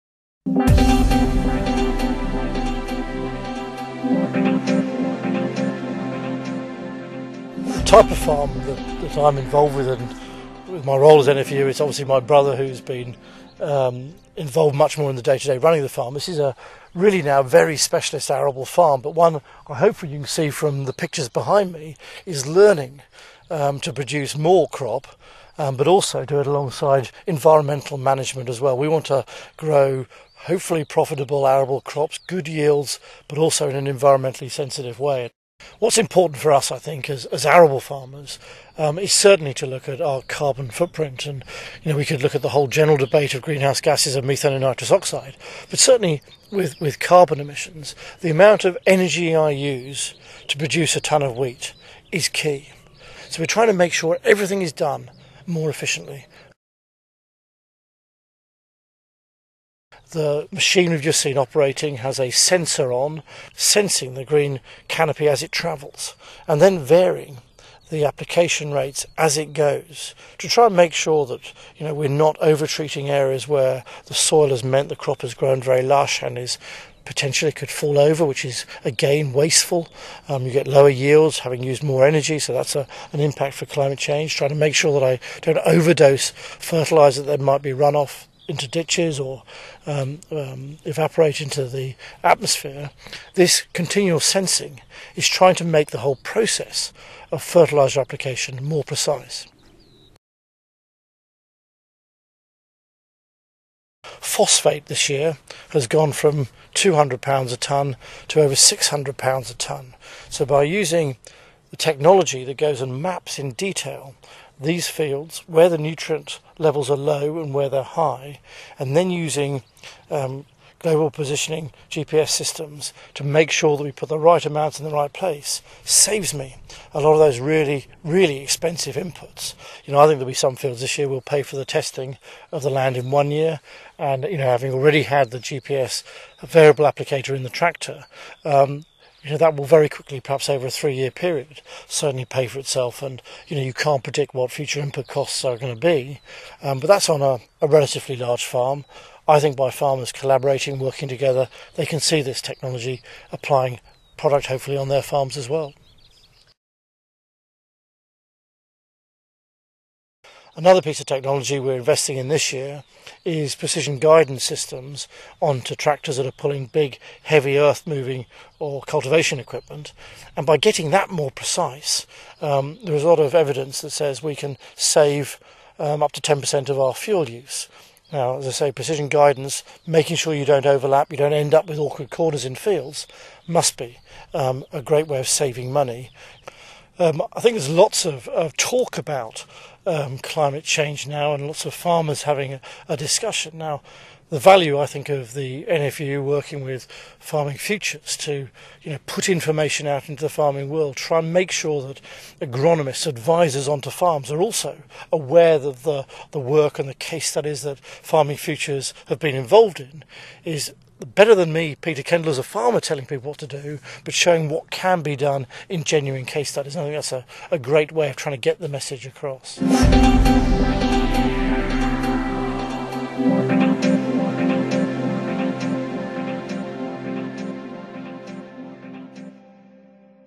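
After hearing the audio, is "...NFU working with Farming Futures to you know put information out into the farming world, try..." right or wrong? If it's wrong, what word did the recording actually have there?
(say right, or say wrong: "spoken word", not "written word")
right.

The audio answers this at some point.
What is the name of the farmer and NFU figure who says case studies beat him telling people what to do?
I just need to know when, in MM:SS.
03:31.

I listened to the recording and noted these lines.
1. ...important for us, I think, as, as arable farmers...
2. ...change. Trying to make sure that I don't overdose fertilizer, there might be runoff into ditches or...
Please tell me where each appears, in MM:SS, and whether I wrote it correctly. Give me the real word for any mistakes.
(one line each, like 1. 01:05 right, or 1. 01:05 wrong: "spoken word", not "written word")
1. 00:35 right
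2. 01:23 right.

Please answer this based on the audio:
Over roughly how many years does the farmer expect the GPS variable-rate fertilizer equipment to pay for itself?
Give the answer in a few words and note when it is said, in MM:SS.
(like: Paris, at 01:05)
3 years, at 02:20.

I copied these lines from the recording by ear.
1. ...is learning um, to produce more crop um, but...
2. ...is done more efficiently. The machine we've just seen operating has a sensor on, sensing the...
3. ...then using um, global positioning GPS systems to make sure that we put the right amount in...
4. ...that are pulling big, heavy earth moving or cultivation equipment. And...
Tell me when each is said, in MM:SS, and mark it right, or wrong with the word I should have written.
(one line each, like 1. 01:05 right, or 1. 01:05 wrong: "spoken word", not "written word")
1. 00:22 right
2. 00:54 right
3. 01:58 right
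4. 02:46 right.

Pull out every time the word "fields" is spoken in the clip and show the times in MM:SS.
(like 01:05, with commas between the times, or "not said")
01:54, 02:10, 03:02.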